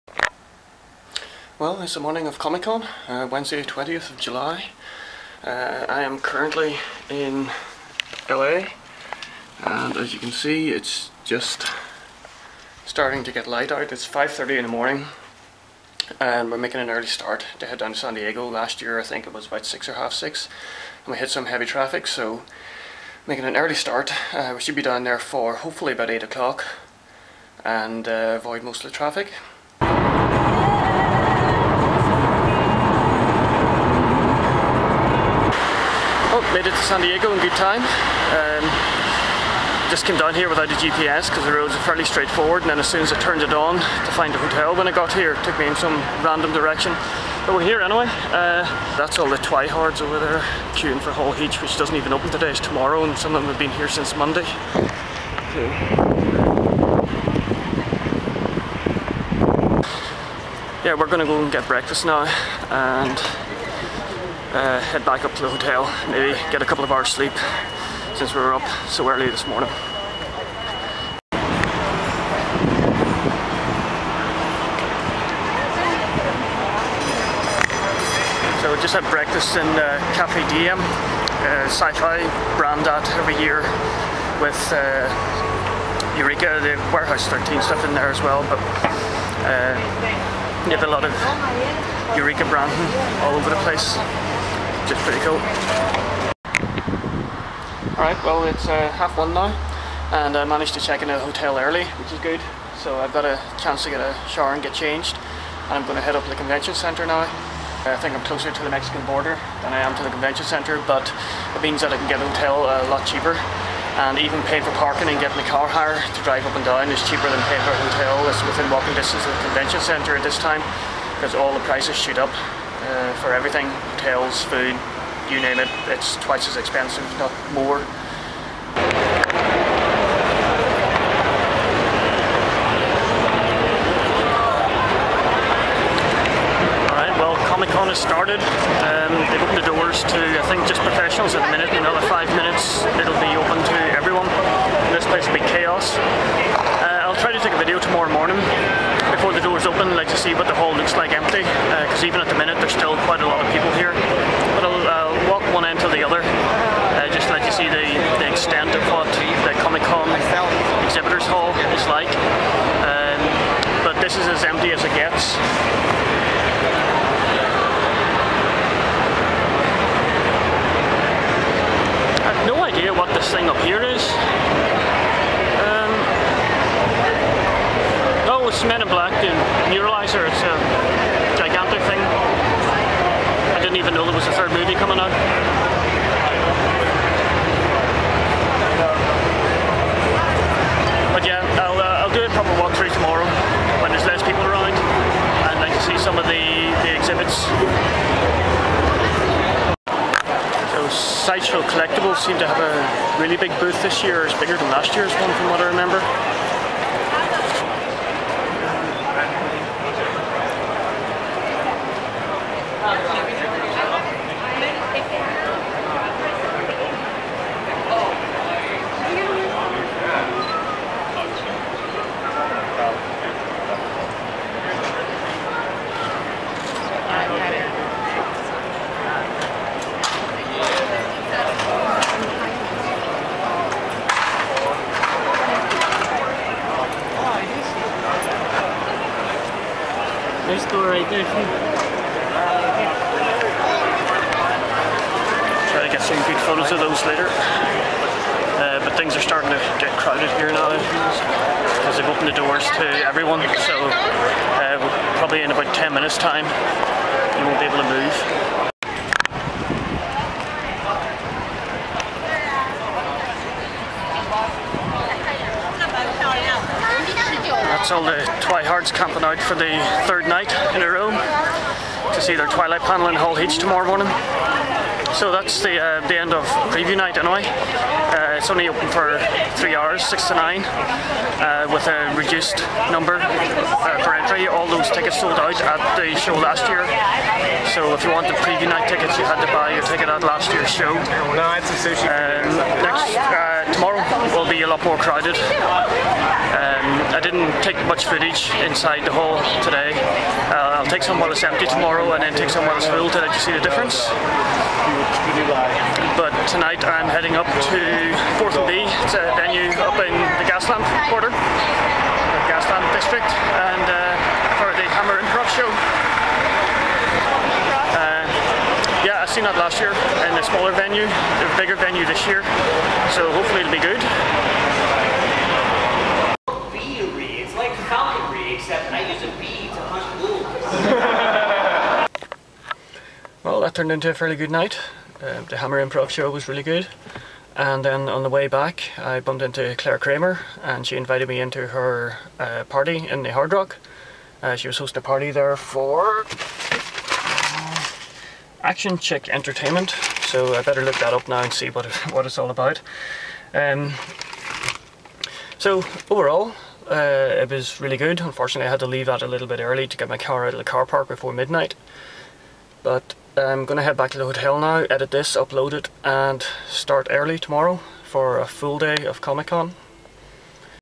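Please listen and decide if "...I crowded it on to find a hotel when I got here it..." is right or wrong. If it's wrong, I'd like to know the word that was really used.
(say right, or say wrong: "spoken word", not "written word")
wrong: "turned", not "crowded".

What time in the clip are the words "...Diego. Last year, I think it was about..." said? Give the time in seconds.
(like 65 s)
18 s.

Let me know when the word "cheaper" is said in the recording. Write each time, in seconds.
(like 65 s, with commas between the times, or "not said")
113 s, 117 s.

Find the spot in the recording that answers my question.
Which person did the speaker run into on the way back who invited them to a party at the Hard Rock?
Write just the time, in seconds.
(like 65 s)
339 s.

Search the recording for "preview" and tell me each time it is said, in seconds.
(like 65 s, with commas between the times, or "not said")
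276 s, 288 s.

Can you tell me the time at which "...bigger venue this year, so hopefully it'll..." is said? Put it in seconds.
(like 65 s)
321 s.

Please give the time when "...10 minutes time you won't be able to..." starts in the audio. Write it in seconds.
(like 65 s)
255 s.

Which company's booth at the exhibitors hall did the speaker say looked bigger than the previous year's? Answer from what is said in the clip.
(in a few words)
Sideshow Collectibles.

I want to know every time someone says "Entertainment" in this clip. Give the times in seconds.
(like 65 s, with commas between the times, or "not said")
349 s.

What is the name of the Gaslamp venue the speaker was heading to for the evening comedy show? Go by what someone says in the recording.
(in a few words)
Portal B.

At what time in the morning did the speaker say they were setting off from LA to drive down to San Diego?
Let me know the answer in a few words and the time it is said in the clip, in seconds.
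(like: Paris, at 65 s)
5:30, at 14 s.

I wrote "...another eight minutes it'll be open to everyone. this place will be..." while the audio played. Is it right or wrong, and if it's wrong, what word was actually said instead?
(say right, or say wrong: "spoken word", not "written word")
wrong: "five", not "eight".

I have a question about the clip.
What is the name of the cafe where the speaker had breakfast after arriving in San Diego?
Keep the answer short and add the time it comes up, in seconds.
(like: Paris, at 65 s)
Cafe Diem, at 80 s.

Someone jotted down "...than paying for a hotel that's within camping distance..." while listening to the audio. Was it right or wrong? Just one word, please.
wrong.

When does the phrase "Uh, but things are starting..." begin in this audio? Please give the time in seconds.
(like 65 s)
248 s.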